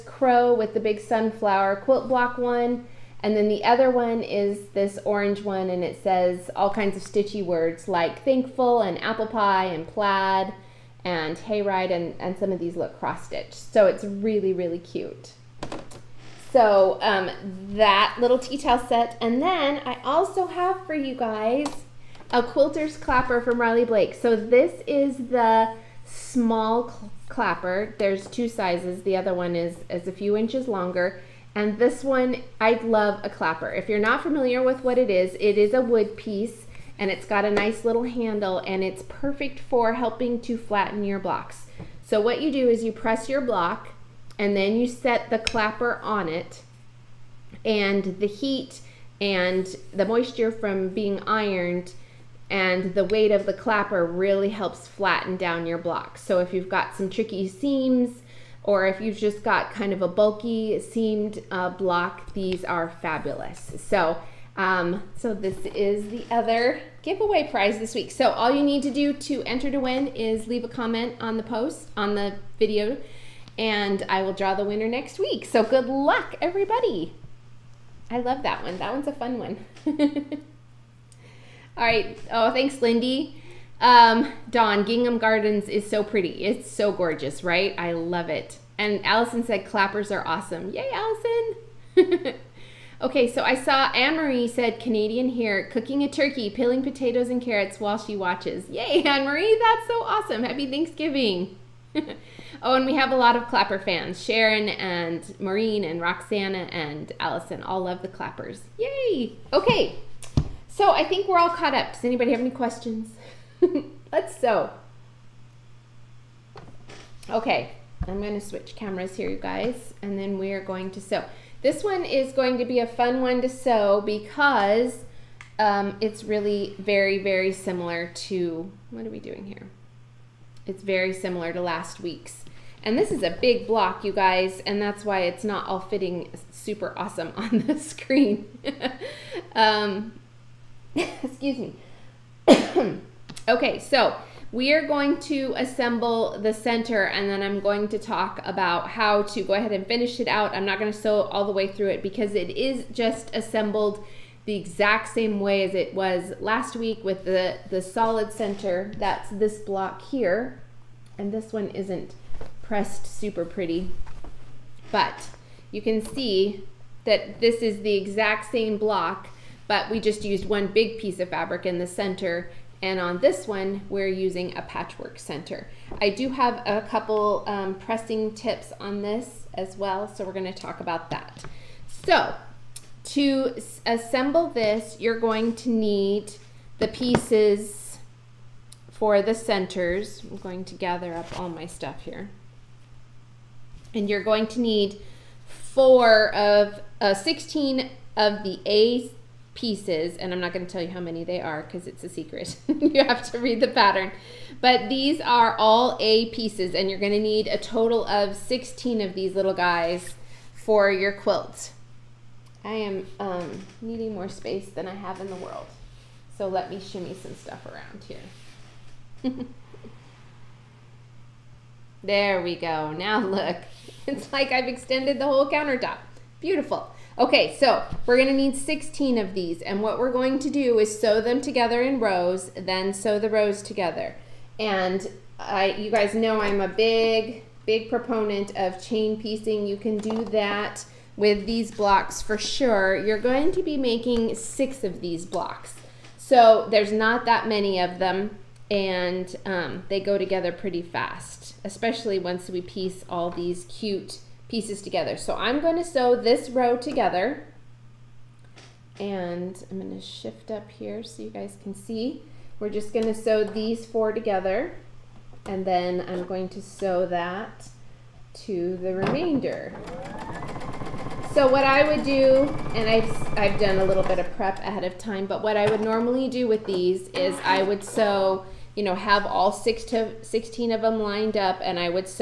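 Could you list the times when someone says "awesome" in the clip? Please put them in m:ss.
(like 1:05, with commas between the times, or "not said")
1:30, 1:40, 2:16.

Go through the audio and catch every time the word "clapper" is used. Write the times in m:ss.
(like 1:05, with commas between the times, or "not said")
0:22, 0:27, 0:33, 0:45, 0:53, 1:29, 1:43, 1:48.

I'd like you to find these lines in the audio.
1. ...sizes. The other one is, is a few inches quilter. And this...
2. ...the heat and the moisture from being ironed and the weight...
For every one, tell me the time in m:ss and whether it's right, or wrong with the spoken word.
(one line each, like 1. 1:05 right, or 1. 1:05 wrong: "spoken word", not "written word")
1. 0:28 wrong: "longer", not "quilter"
2. 0:48 right.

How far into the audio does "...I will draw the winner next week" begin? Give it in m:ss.
1:14.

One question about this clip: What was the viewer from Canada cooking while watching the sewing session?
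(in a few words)
turkey.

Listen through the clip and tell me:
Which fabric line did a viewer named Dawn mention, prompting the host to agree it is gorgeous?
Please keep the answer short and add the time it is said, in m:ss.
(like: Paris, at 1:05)
Gingham Gardens, at 1:24.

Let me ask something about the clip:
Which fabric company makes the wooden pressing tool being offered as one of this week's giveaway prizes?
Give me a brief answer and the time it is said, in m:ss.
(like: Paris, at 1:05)
Riley Blake, at 0:23.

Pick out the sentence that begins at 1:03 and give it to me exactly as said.
So, um, so this is the other giveaway prize this week.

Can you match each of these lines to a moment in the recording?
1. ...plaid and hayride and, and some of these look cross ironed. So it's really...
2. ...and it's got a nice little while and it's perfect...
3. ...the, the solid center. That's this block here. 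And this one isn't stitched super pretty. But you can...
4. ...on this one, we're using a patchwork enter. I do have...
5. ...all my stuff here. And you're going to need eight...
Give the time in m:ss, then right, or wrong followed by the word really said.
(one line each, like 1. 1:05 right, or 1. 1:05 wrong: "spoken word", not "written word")
1. 0:09 wrong: "stitched", not "ironed"
2. 0:36 wrong: "handle", not "while"
3. 2:37 wrong: "pressed", not "stitched"
4. 2:52 wrong: "center", not "enter"
5. 3:11 wrong: "four", not "eight".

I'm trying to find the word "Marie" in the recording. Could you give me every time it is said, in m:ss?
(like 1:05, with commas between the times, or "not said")
1:33, 1:39.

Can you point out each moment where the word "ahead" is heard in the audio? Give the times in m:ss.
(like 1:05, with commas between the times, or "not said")
2:29, 4:34.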